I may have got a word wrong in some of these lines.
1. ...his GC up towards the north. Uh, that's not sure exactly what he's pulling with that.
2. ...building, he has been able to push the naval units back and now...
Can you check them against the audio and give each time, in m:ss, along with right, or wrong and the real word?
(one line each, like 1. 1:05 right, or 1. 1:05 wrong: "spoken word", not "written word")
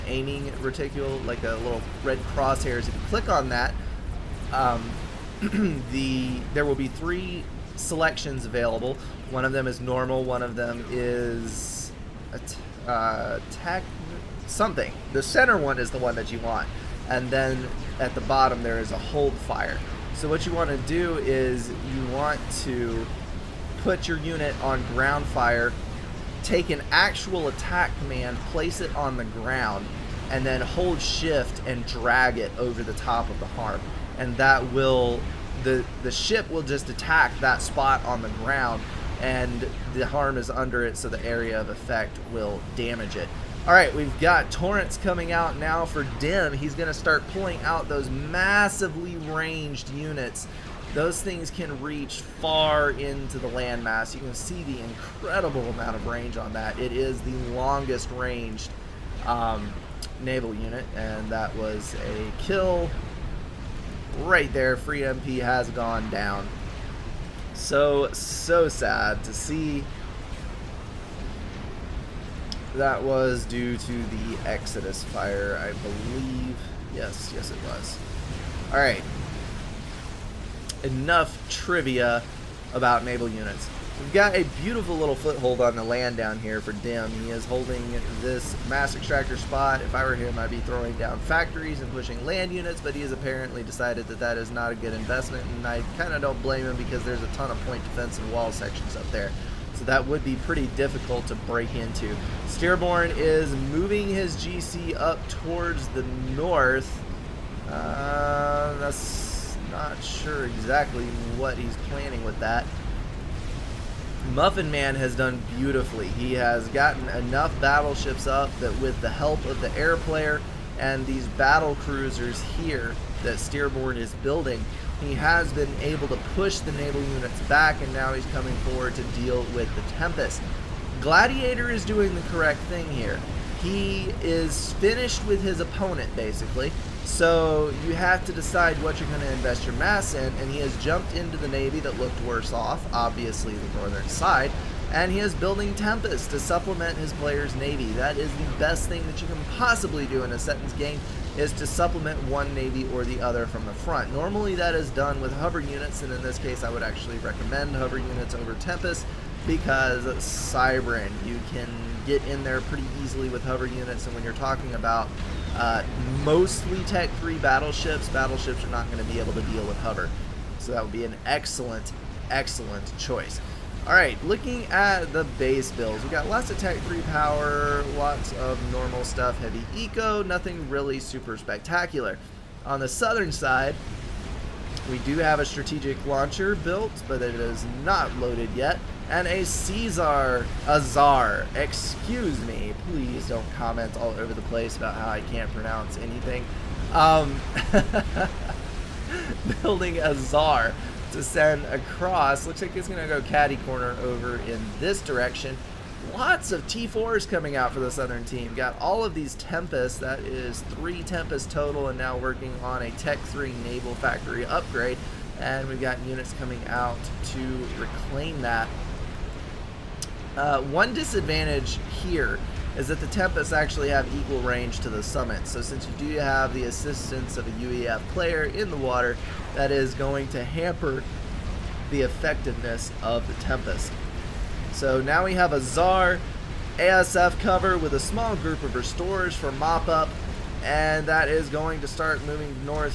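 1. 1:44 wrong: "planning", not "pulling"
2. 2:04 right.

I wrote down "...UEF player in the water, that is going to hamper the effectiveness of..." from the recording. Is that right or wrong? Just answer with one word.
right.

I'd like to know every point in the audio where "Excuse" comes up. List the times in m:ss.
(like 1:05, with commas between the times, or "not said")
3:11.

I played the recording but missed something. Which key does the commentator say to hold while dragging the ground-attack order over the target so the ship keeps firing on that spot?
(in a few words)
Shift.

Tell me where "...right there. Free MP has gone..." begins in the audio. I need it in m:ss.
1:04.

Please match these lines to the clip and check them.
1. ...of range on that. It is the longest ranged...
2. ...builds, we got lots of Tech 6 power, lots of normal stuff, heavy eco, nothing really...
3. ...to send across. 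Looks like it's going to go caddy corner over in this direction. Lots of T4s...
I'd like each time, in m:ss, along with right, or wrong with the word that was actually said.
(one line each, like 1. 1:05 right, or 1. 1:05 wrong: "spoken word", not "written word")
1. 0:55 right
2. 2:55 wrong: "3", not "6"
3. 3:21 right.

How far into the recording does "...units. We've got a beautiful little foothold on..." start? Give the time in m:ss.
1:23.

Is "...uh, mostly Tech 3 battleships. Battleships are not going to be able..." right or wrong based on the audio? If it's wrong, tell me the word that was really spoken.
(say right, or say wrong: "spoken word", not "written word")
right.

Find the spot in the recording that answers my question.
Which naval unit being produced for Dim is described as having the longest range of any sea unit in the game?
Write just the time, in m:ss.
0:44.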